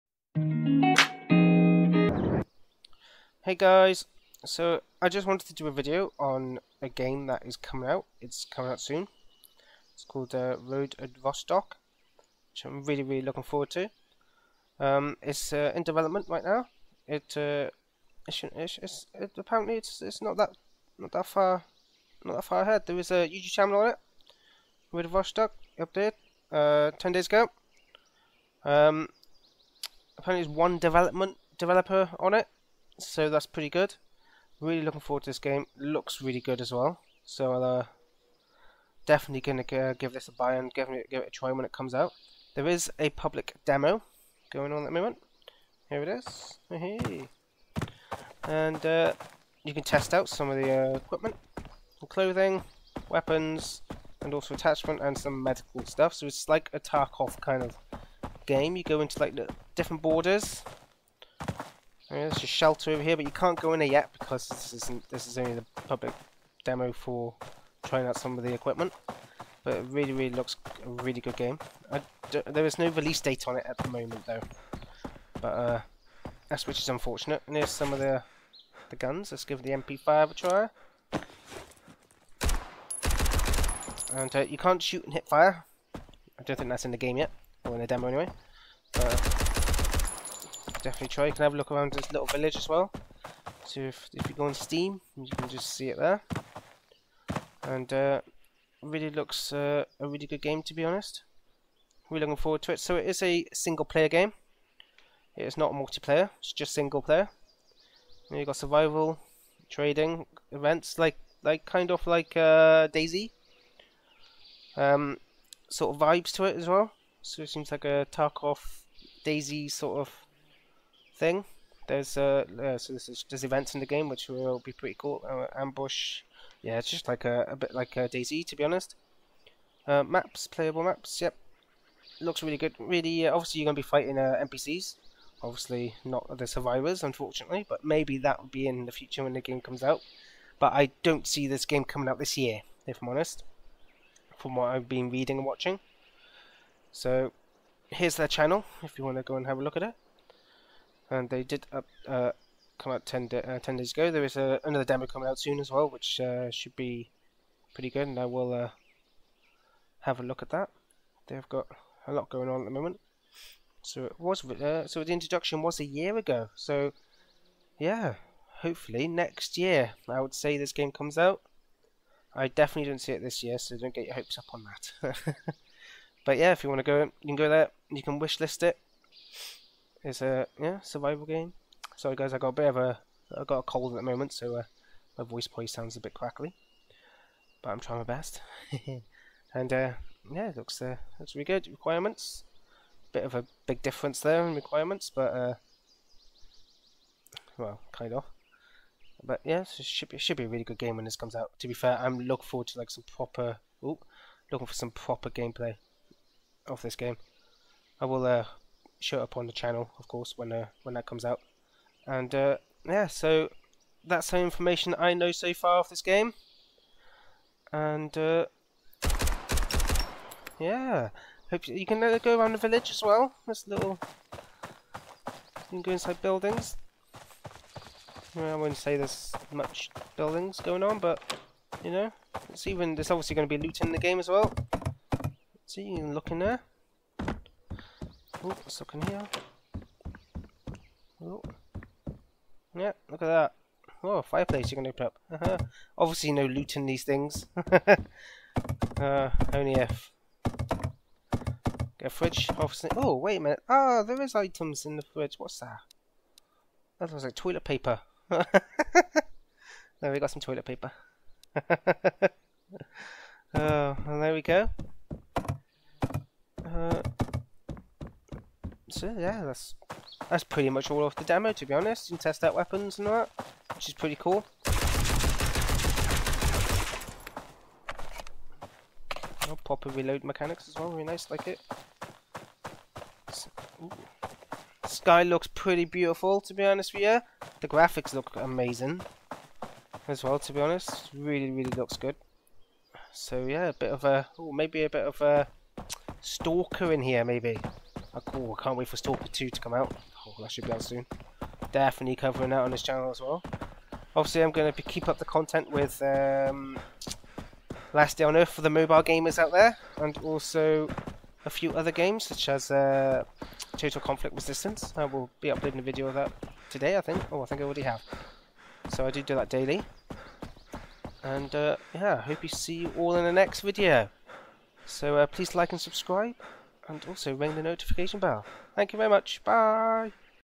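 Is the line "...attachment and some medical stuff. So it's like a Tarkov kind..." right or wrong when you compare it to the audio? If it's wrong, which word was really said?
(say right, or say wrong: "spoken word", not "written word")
right.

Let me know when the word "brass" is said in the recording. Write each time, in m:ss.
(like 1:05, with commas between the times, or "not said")
not said.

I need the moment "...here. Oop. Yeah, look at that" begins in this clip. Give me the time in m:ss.
3:59.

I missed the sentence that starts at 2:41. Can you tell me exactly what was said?
They've got a lot going on at the moment.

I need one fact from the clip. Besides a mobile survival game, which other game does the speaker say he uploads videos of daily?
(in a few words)
Total Conflict Resistance.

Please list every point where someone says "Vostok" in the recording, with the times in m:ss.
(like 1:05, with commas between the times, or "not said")
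0:11, 0:25.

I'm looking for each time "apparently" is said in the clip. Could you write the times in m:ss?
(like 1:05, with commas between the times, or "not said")
0:19, 0:30.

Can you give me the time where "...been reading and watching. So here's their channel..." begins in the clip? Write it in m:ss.
2:24.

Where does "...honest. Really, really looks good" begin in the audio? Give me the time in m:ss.
4:50.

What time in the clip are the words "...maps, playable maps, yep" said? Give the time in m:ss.
2:10.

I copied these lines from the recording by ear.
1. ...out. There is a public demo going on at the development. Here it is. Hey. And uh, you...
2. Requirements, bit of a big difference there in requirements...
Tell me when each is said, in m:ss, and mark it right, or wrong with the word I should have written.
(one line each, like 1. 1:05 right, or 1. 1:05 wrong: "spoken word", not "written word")
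1. 0:41 wrong: "moment", not "development"
2. 3:11 right.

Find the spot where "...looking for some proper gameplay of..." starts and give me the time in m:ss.
3:24.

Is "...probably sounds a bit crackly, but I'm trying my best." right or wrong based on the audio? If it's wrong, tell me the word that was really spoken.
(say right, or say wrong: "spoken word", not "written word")
right.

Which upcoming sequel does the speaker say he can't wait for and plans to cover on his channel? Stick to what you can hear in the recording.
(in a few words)
Stalker 2.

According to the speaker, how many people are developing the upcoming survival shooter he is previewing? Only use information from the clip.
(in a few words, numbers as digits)
1.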